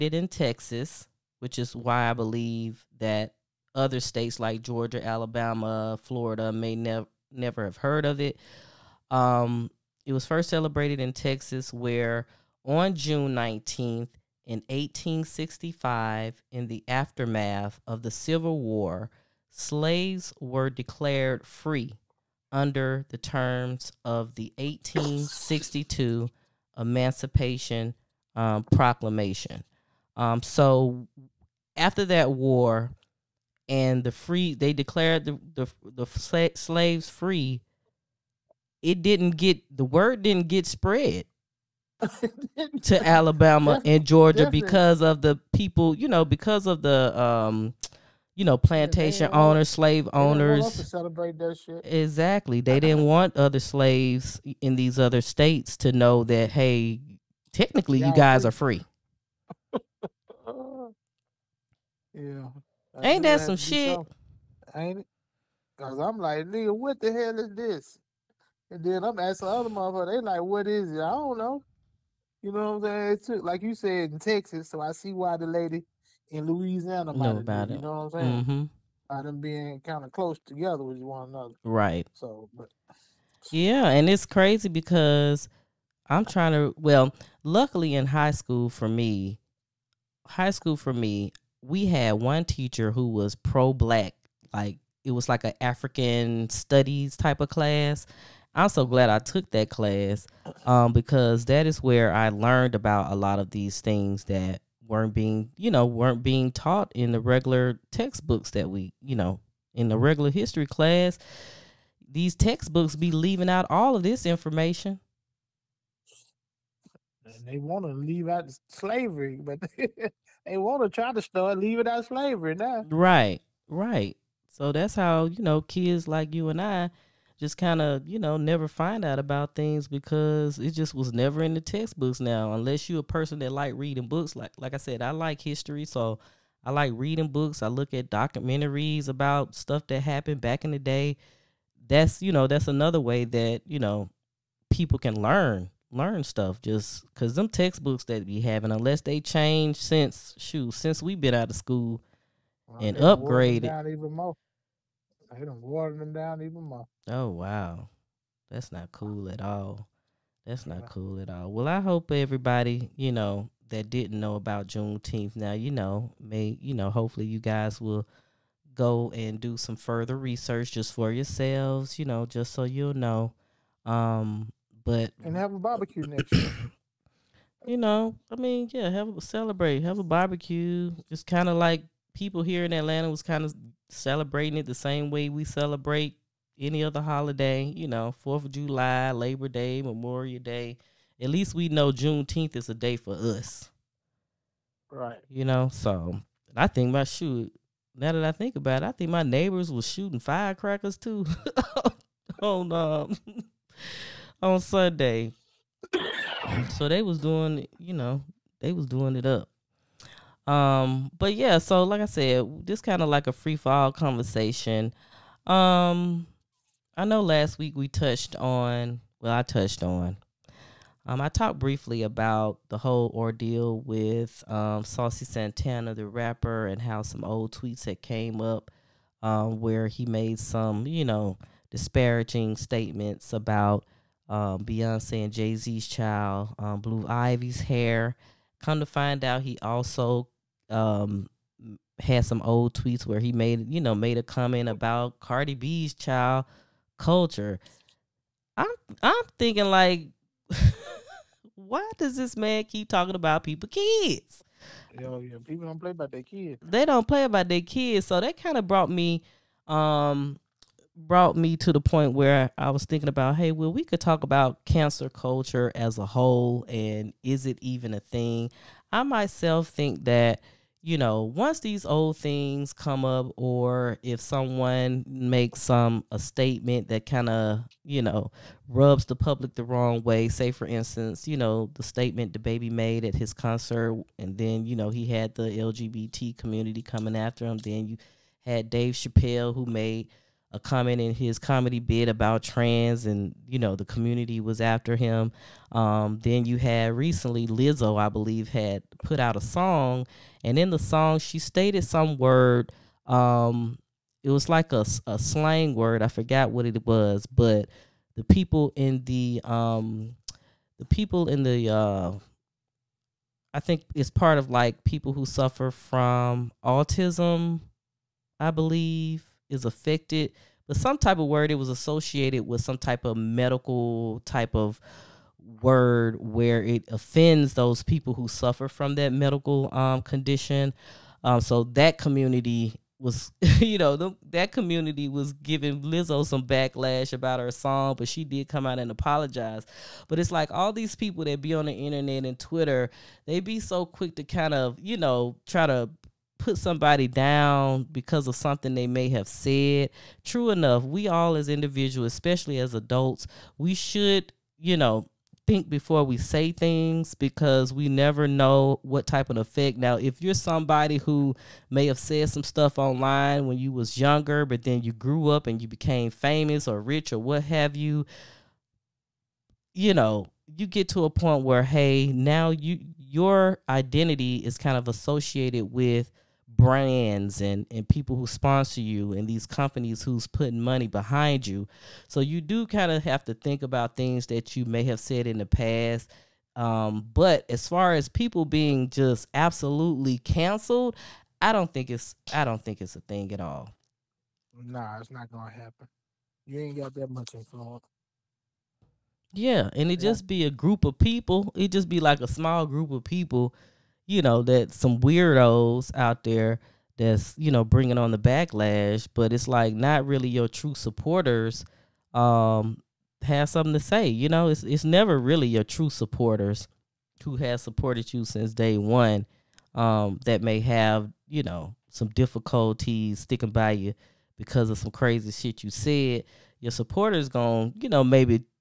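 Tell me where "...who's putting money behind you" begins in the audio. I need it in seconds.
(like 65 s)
380 s.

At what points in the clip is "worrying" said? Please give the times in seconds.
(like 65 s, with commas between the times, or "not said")
not said.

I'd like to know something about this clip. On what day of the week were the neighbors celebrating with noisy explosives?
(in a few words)
Sunday.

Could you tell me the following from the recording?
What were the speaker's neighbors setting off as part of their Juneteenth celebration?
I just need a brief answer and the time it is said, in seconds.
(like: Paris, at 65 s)
Firecrackers, at 200 s.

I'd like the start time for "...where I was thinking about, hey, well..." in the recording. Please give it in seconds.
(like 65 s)
262 s.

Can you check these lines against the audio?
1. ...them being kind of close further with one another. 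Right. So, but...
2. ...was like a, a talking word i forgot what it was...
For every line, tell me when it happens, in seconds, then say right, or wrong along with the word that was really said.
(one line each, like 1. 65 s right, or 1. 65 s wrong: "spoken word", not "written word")
1. 79 s wrong: "together", not "further"
2. 304 s wrong: "slang", not "talking".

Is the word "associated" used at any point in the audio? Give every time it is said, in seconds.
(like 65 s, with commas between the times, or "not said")
321 s, 374 s.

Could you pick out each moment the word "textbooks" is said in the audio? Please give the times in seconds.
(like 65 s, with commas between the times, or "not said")
107 s, 112 s, 131 s, 147 s.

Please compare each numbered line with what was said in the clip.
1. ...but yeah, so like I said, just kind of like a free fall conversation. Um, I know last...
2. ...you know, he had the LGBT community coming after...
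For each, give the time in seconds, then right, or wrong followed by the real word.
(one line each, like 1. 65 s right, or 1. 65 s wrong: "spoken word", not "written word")
1. 211 s right
2. 284 s right.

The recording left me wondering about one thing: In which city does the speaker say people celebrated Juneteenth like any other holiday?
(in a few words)
Atlanta.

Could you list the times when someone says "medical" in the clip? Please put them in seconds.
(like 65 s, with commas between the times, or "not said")
323 s, 329 s.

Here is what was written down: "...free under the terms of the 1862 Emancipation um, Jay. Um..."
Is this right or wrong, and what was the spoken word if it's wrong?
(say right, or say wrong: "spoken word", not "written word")
wrong: "Proclamation", not "Jay".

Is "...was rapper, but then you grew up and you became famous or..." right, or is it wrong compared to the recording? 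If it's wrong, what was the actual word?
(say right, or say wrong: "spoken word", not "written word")
wrong: "younger", not "rapper".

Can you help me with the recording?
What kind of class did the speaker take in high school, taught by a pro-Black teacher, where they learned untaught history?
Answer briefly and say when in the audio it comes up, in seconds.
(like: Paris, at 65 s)
African studies, at 95 s.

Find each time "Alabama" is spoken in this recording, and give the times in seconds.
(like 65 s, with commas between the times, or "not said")
5 s, 43 s.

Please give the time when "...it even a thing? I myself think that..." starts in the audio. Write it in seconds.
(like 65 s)
267 s.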